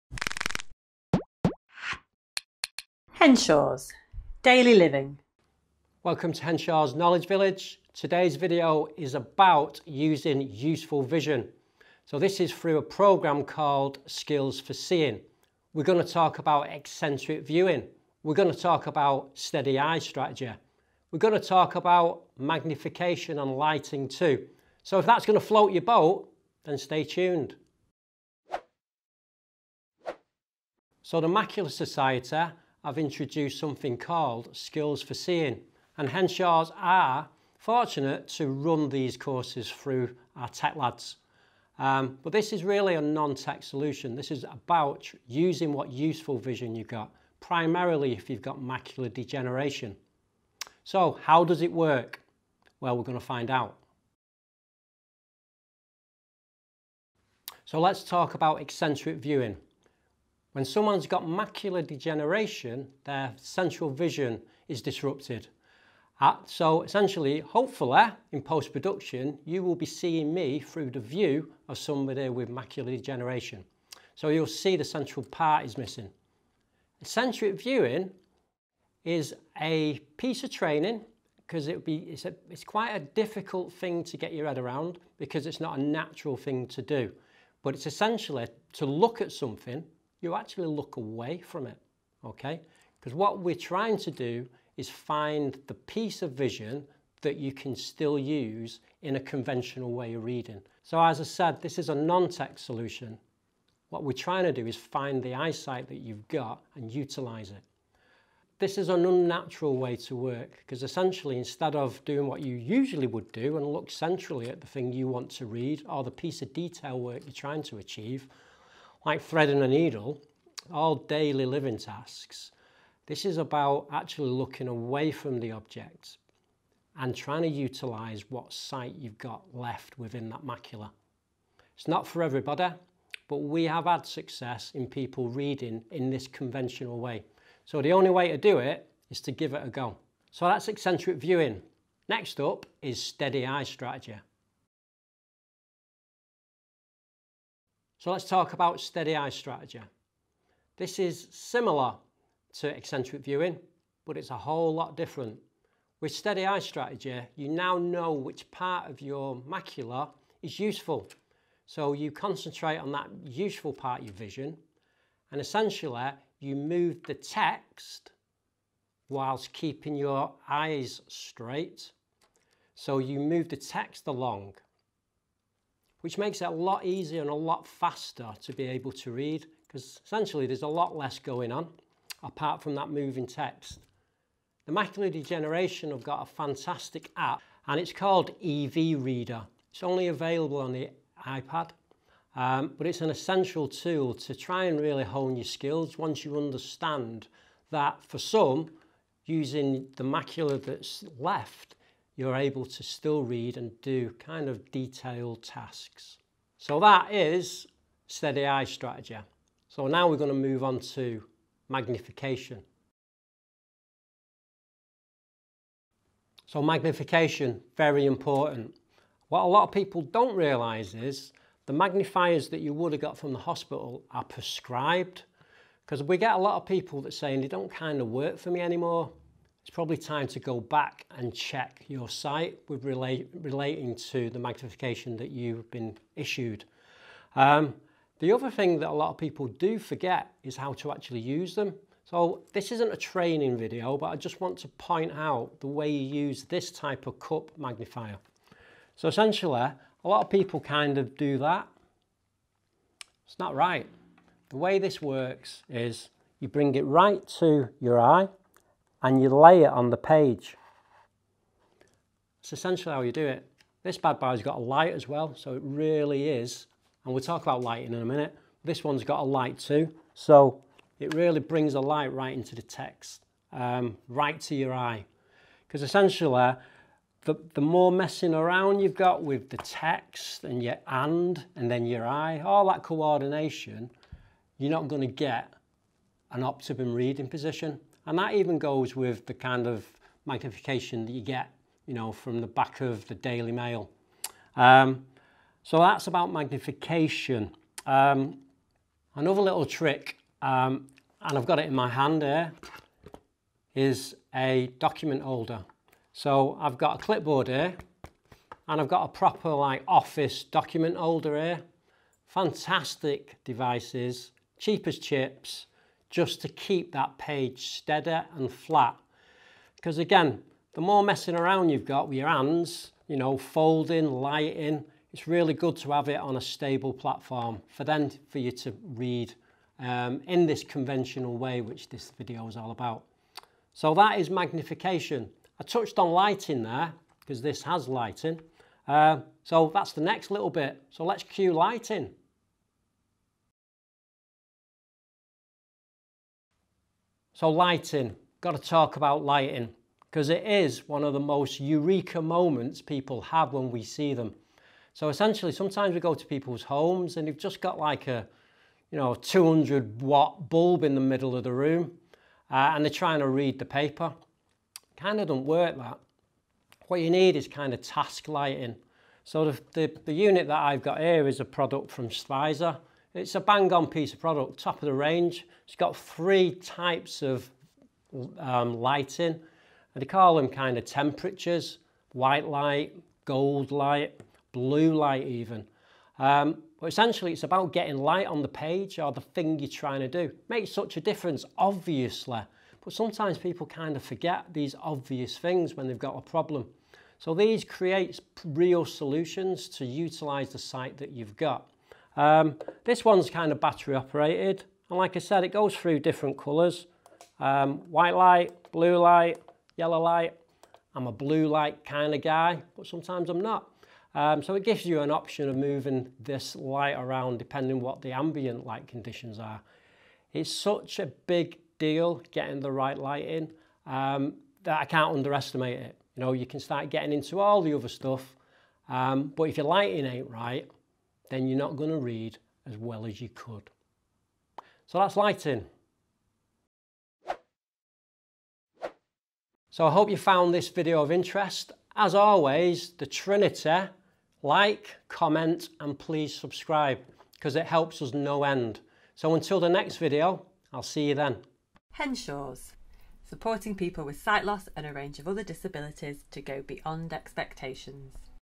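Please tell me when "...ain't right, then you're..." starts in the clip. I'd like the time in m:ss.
7:10.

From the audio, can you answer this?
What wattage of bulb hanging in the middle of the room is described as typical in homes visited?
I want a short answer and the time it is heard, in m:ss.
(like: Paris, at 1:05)
200 watt, at 5:59.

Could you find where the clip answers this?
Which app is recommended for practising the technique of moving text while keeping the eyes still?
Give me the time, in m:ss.
3:08.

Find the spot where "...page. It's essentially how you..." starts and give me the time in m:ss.
4:19.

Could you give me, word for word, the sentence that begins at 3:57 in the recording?
Um, the other thing that a lot of people do forget is how to actually use them.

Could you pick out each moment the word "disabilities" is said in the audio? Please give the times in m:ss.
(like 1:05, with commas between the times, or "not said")
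7:35.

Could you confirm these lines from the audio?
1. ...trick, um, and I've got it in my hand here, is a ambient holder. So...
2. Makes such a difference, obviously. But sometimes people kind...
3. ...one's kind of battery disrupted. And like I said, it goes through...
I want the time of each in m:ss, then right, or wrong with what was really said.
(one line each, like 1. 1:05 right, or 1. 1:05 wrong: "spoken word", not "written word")
1. 4:59 wrong: "document", not "ambient"
2. 6:30 right
3. 6:43 wrong: "operated", not "disrupted".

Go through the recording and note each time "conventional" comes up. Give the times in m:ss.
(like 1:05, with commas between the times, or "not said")
1:39, 2:16, 5:30.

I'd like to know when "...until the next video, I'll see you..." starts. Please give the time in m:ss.
7:29.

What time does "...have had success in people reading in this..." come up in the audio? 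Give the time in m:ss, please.
2:13.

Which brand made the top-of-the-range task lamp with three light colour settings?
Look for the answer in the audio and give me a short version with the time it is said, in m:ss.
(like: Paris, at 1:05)
Stryzer, at 6:12.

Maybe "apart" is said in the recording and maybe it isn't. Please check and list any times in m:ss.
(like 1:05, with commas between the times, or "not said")
3:02.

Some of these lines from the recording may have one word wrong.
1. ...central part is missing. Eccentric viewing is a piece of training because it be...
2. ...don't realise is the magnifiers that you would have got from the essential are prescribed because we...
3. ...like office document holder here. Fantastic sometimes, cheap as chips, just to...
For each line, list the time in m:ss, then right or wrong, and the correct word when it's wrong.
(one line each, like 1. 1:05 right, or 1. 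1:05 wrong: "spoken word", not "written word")
1. 1:14 right
2. 3:40 wrong: "hospital", not "essential"
3. 5:09 wrong: "devices", not "sometimes".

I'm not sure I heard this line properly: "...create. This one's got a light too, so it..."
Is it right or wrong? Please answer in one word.
wrong.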